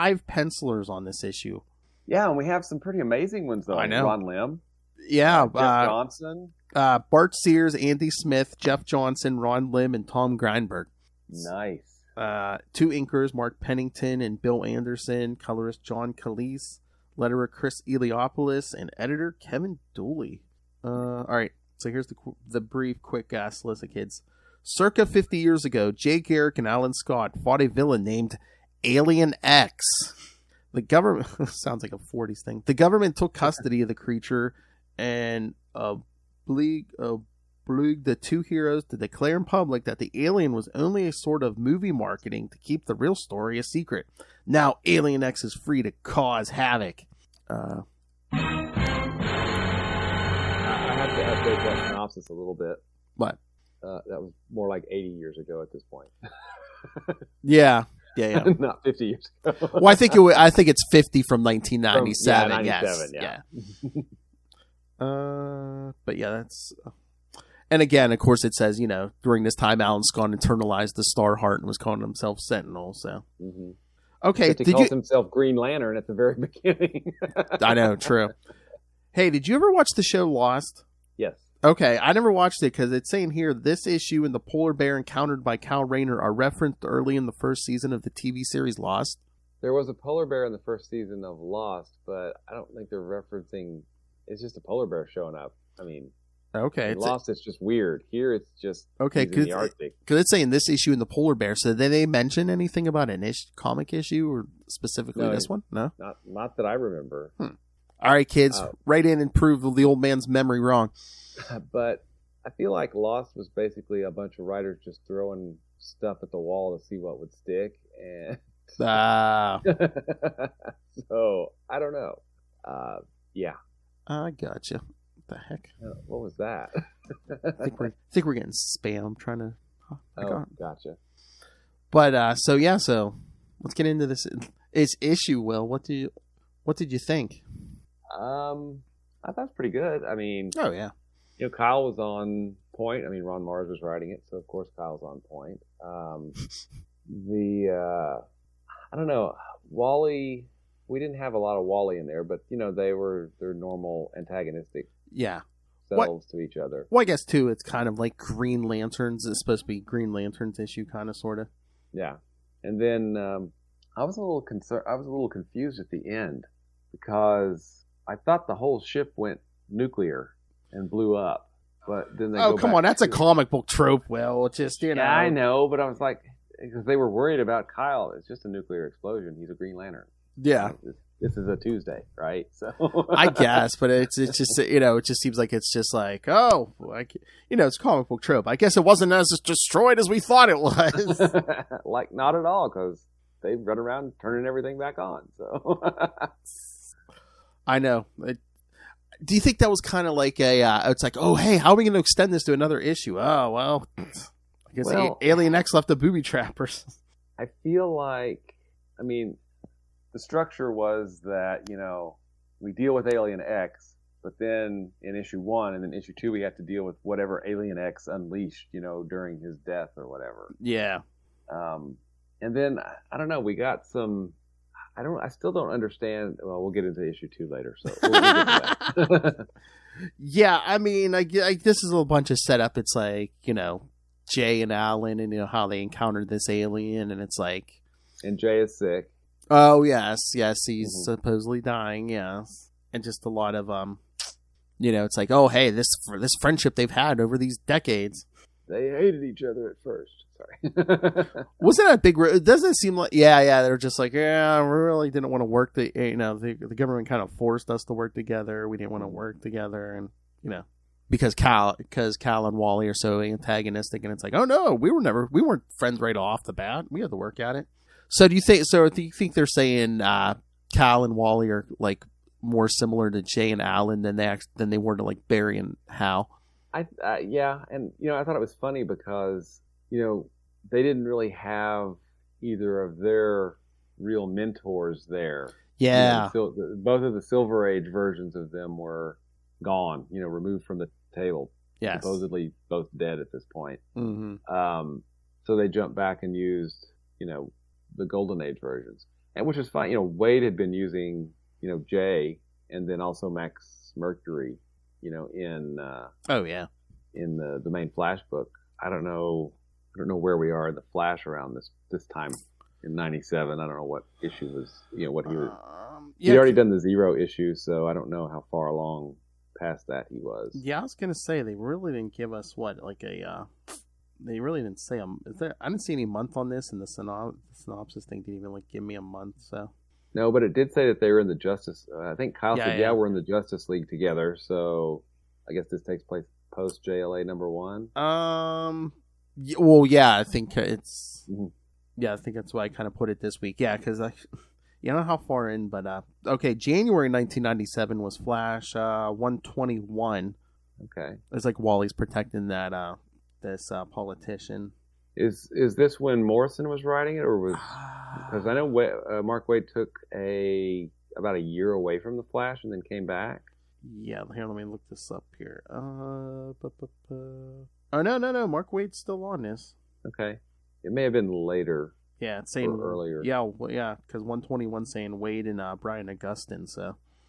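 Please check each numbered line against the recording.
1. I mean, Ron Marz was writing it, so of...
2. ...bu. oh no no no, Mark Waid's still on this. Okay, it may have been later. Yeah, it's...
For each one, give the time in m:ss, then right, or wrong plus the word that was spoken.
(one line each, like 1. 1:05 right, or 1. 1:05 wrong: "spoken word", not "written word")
1. 2:23 right
2. 6:07 right.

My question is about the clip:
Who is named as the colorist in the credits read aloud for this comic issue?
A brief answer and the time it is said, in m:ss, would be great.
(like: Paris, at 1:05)
John Kalisz, at 0:15.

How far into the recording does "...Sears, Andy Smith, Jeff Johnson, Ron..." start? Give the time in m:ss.
0:07.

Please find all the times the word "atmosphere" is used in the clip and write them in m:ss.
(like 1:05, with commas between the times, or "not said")
not said.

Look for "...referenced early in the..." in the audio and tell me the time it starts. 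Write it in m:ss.
1:26.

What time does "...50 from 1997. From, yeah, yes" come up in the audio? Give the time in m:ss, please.
1:00.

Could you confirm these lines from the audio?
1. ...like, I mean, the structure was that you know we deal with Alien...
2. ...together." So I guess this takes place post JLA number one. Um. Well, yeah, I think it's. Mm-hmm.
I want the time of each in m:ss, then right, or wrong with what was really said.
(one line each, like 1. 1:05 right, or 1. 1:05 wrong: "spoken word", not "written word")
1. 3:27 right
2. 5:33 right.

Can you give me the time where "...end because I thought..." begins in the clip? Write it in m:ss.
2:46.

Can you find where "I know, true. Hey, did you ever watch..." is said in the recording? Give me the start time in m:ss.
1:17.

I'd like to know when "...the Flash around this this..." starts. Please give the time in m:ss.
5:10.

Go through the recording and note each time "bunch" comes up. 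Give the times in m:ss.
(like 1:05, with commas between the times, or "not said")
1:54, 3:52.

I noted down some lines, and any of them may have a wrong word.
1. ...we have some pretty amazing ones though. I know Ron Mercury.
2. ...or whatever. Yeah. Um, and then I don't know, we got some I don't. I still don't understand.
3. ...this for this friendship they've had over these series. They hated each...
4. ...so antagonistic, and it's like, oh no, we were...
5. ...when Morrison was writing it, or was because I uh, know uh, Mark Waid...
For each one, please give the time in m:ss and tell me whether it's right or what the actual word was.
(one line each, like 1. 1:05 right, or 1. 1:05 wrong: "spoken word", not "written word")
1. 0:02 wrong: "Lim", not "Mercury"
2. 3:39 right
3. 4:05 wrong: "decades", not "series"
4. 4:22 right
5. 5:55 right.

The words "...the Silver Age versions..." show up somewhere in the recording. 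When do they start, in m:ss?
4:47.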